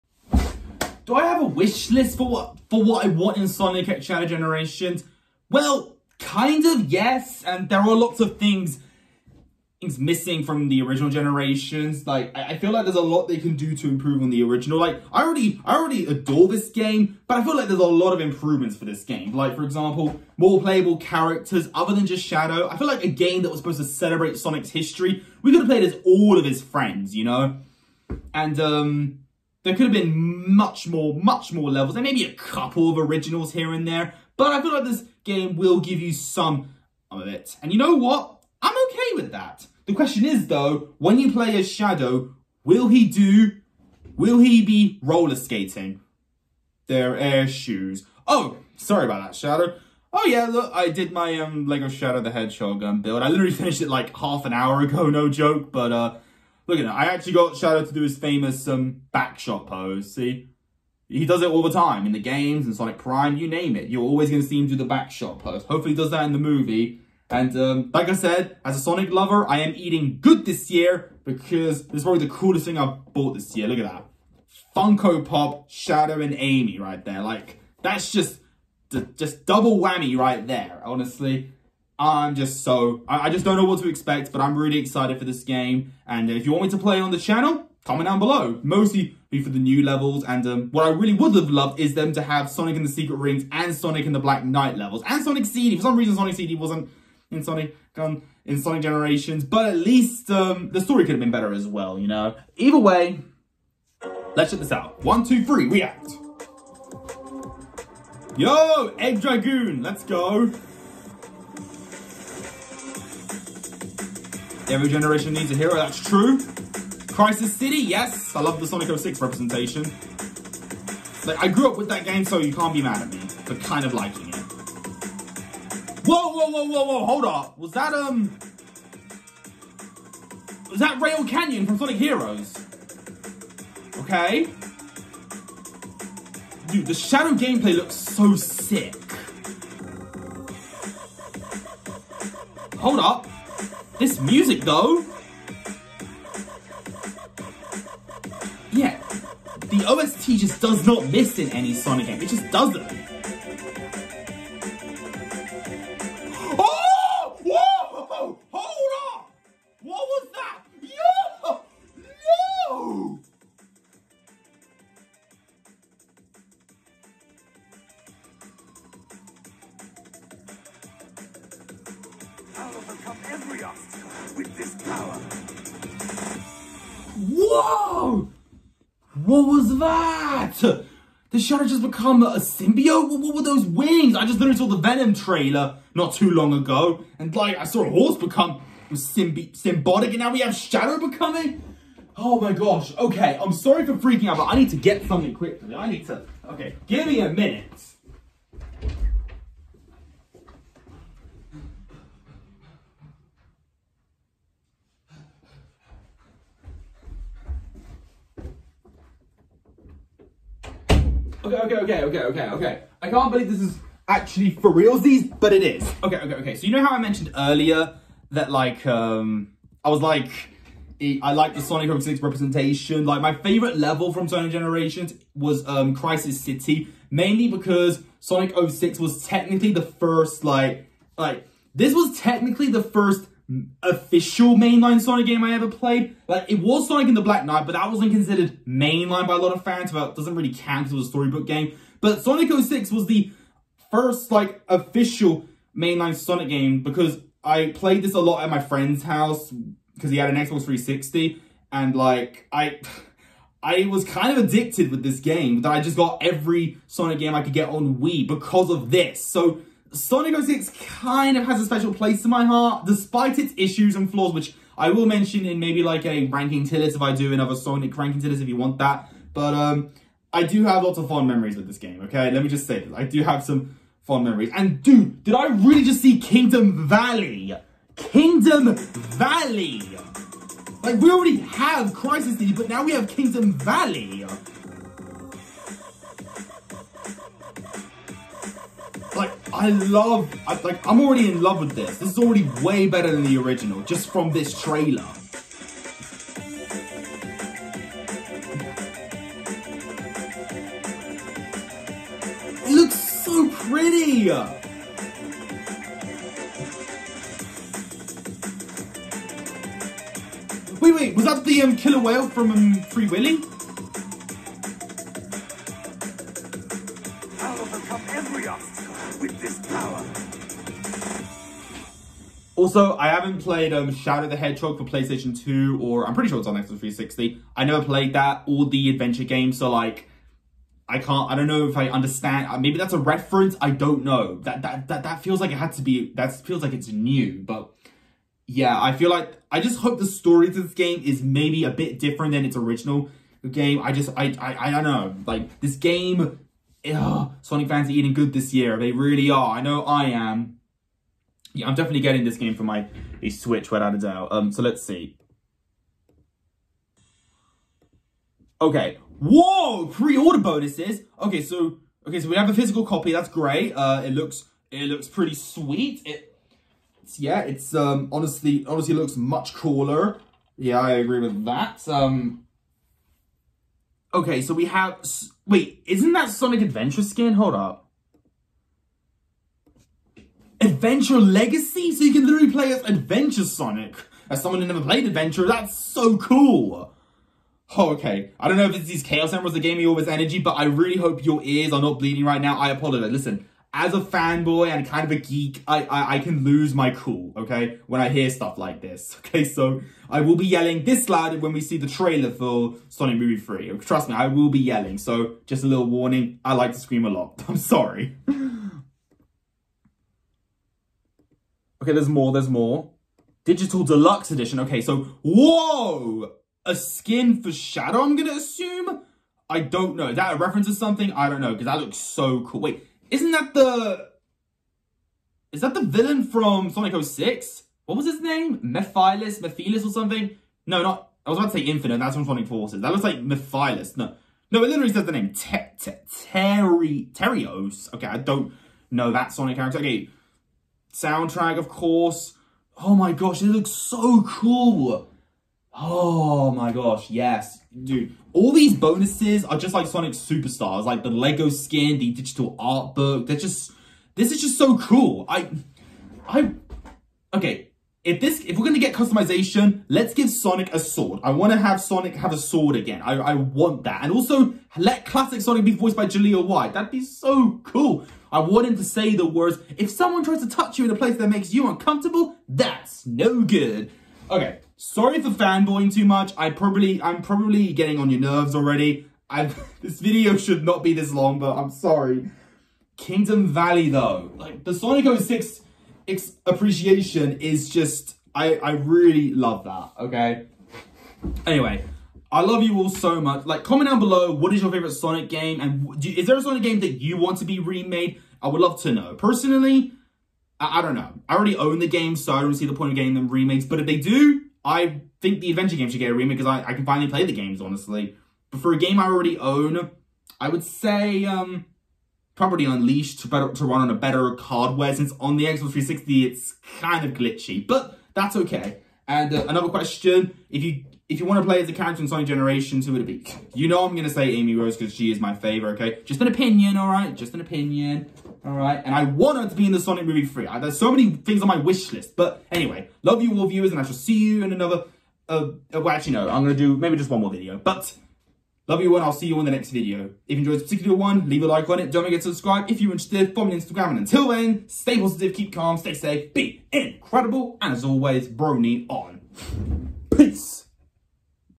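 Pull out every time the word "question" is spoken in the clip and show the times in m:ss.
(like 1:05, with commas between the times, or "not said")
0:39, 8:39.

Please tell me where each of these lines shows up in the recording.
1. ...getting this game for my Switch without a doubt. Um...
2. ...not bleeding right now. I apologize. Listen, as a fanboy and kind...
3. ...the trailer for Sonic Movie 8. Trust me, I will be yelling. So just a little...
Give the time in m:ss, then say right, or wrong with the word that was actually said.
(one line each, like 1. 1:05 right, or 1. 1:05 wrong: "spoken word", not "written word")
1. 5:52 right
2. 6:31 right
3. 6:41 wrong: "3", not "8".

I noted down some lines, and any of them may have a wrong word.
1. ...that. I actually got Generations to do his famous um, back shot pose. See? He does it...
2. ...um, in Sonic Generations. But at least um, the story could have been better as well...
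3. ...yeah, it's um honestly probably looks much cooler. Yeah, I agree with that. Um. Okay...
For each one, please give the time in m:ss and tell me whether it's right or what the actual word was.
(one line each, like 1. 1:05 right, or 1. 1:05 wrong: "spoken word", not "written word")
1. 0:56 wrong: "Shadow", not "Generations"
2. 1:37 right
3. 6:07 wrong: "honestly", not "probably".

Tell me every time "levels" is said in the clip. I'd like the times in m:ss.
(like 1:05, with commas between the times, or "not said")
0:31, 1:29, 1:34, 3:43.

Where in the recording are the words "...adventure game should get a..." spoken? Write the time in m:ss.
8:25.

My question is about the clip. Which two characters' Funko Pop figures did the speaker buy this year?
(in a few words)
Shadow and Amy.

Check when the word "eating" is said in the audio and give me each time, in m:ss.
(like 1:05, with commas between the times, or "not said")
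1:09, 5:47.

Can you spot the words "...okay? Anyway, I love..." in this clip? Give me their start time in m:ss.
8:10.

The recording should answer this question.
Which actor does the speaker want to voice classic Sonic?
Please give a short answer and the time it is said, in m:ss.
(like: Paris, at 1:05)
Jaleel White, at 7:46.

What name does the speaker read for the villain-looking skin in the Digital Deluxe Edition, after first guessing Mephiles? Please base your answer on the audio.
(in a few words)
Terios.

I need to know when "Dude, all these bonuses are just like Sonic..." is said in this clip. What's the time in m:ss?
7:27.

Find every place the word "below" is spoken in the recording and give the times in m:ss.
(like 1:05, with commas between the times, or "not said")
1:28, 8:13.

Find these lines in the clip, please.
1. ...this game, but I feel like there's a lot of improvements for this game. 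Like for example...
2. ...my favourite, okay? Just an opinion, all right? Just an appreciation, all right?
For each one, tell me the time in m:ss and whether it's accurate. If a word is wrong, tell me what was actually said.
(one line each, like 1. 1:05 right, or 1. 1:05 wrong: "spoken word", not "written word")
1. 0:16 right
2. 8:45 wrong: "opinion", not "appreciation".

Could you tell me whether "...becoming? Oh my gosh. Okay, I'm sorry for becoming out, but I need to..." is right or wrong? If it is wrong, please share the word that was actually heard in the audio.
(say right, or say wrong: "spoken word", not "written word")
wrong: "freaking", not "becoming".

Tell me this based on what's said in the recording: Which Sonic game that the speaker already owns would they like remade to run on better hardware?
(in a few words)
Unleashed.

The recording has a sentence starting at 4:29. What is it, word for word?
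But um, I do have lots of fond memories with this game, okay?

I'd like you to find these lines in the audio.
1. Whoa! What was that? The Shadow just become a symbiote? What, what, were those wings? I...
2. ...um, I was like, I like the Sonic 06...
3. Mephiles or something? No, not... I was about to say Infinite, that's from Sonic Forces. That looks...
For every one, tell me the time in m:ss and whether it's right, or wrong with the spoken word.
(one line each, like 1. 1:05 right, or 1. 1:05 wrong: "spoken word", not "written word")
1. 2:57 right
2. 3:38 right
3. 7:09 right.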